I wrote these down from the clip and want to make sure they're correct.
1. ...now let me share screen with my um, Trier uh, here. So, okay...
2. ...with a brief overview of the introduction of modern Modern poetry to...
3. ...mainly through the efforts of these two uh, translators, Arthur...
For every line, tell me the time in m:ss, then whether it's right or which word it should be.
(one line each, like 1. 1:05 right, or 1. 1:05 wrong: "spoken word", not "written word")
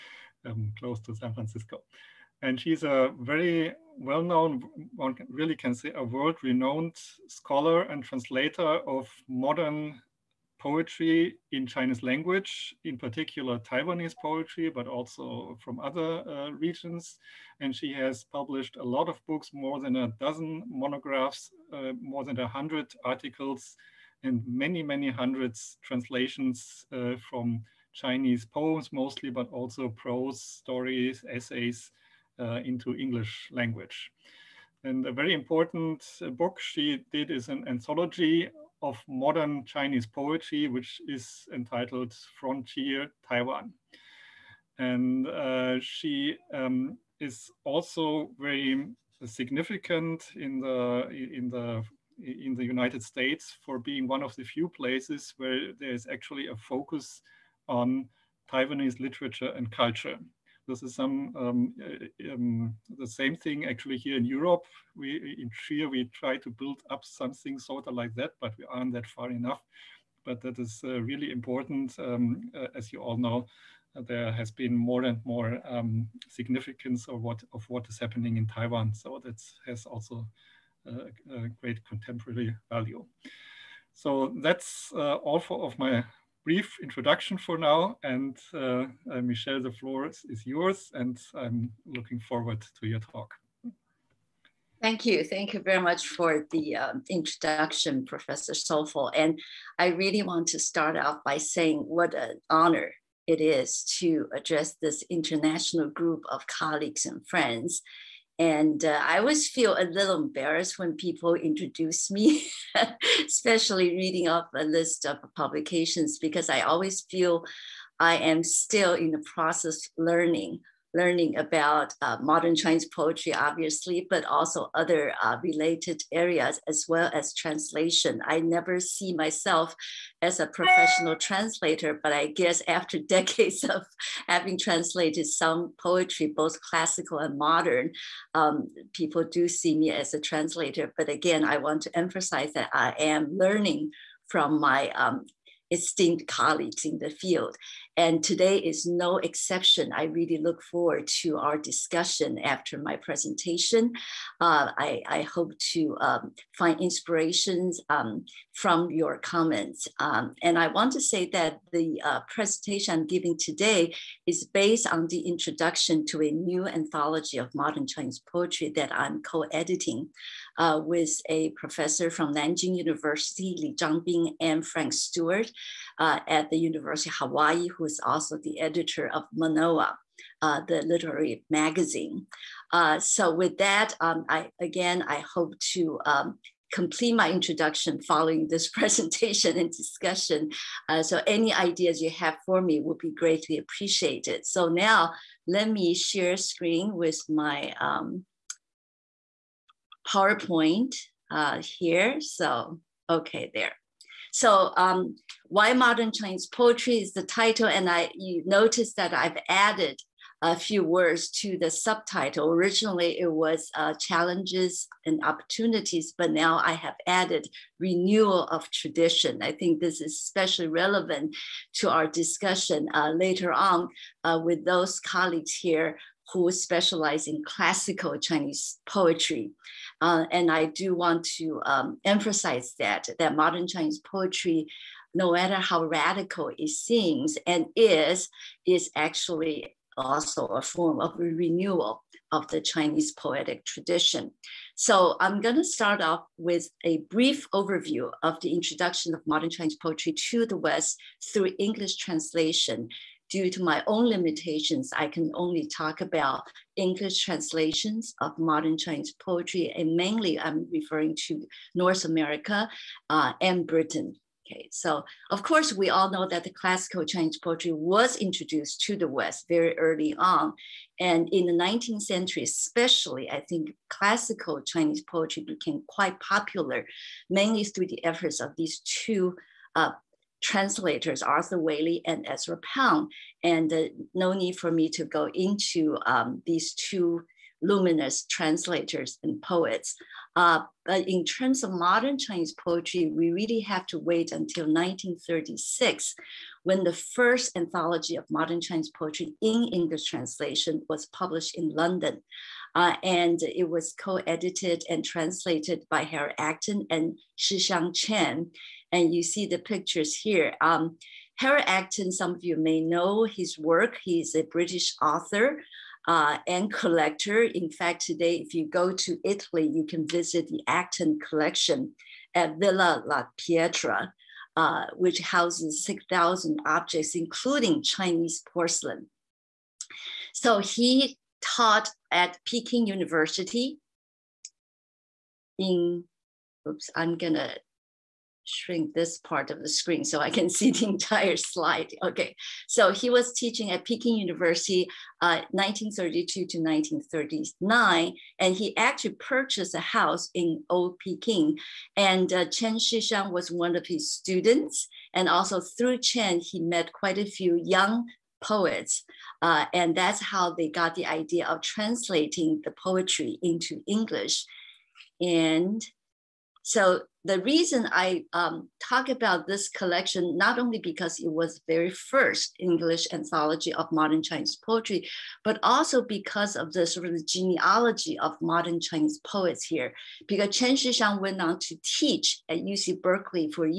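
1. 3:14 wrong: "PowerPoint", not "Trier"
2. 4:06 wrong: "Chinese", not "Modern"
3. 4:37 right.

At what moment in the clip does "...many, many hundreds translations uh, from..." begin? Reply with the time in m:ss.
0:24.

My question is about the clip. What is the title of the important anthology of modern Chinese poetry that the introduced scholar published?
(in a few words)
Frontier Taiwan.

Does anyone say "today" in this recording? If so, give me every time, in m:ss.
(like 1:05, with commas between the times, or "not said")
2:28, 2:43, 5:18.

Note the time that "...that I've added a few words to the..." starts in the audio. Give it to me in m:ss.
3:28.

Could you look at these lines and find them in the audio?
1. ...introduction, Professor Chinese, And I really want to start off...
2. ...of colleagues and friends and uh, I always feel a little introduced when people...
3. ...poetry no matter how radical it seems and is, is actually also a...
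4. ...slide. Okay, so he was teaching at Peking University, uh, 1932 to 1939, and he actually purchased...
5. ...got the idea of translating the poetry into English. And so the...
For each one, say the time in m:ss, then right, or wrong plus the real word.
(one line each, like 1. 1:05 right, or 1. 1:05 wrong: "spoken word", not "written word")
1. 1:37 wrong: "Soulful", not "Chinese"
2. 1:46 wrong: "embarrassed", not "introduced"
3. 3:54 right
4. 5:41 right
5. 6:00 right.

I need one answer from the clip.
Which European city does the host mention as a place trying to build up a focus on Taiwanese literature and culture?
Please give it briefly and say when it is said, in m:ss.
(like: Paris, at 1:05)
Trier, at 1:05.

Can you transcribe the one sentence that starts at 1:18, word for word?
So that has also a, uh, a great contemporary value.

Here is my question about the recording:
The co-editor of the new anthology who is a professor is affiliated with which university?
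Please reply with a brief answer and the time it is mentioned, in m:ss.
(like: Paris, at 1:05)
Nanjing University, at 2:52.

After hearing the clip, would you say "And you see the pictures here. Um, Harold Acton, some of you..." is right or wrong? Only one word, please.
right.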